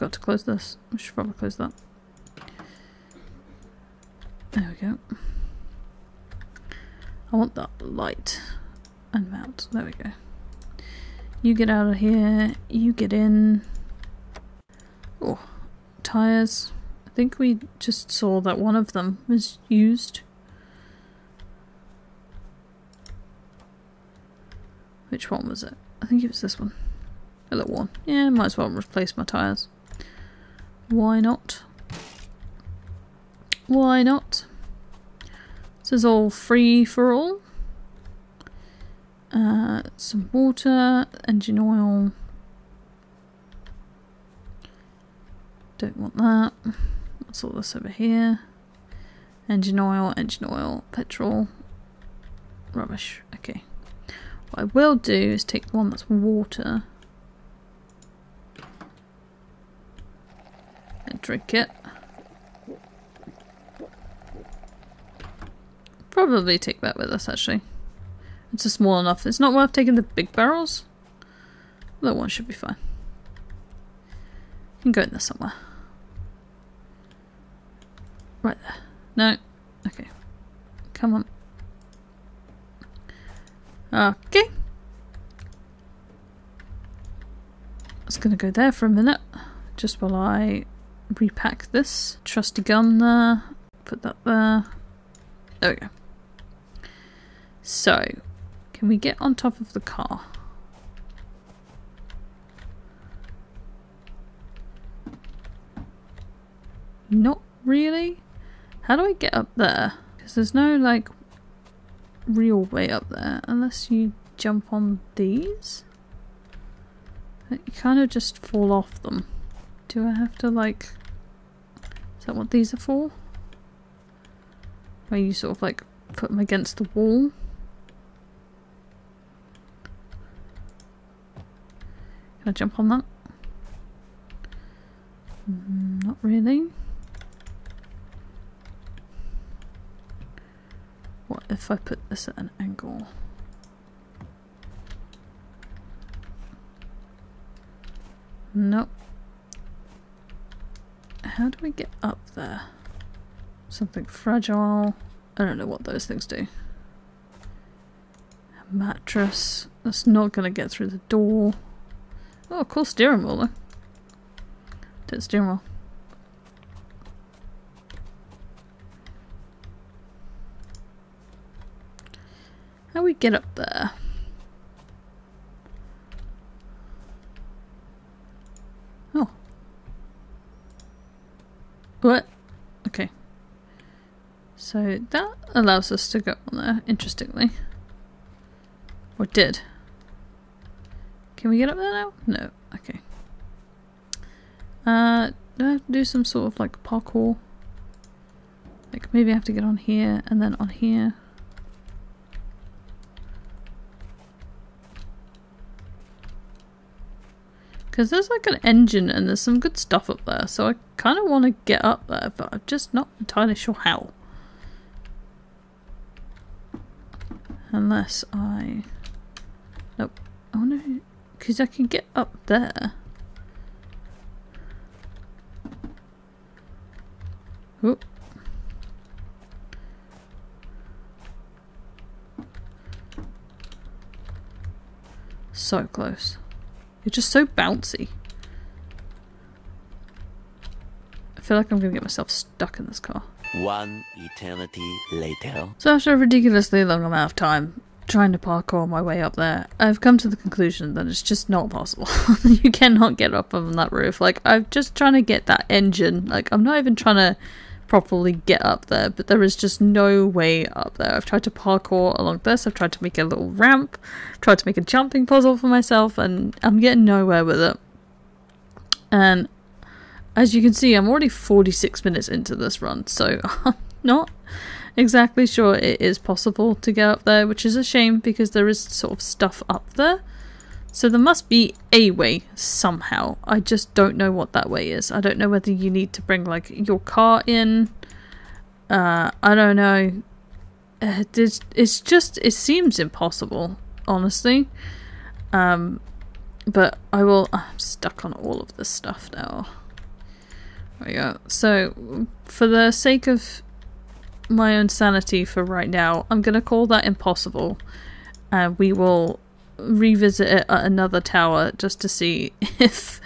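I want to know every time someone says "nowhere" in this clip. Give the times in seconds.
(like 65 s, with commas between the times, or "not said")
267 s.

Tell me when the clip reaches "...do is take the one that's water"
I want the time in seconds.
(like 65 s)
54 s.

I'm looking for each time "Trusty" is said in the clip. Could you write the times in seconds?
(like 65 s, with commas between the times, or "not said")
92 s.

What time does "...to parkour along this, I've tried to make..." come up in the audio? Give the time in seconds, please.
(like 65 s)
261 s.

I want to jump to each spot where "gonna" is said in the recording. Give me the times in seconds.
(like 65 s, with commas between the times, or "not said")
88 s, 241 s.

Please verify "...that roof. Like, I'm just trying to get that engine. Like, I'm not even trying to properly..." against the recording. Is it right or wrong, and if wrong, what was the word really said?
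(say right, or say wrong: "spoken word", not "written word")
right.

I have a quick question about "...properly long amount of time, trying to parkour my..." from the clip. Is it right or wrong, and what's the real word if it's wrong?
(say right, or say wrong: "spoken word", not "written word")
wrong: "ridiculously", not "properly".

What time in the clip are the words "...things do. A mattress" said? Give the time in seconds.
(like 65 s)
156 s.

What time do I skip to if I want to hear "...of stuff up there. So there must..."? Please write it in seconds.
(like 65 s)
279 s.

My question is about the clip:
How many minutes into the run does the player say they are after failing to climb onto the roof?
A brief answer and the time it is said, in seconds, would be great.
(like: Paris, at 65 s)
46, at 271 s.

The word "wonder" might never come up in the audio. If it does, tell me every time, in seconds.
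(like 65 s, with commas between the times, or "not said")
220 s.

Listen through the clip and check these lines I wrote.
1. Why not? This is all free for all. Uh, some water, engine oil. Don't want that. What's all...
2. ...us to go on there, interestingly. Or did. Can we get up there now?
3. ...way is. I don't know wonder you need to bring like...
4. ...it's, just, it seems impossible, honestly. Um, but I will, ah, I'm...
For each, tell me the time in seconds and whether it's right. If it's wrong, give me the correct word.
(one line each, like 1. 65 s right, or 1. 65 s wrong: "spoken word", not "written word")
1. 33 s right
2. 185 s right
3. 284 s wrong: "whether", not "wonder"
4. 291 s right.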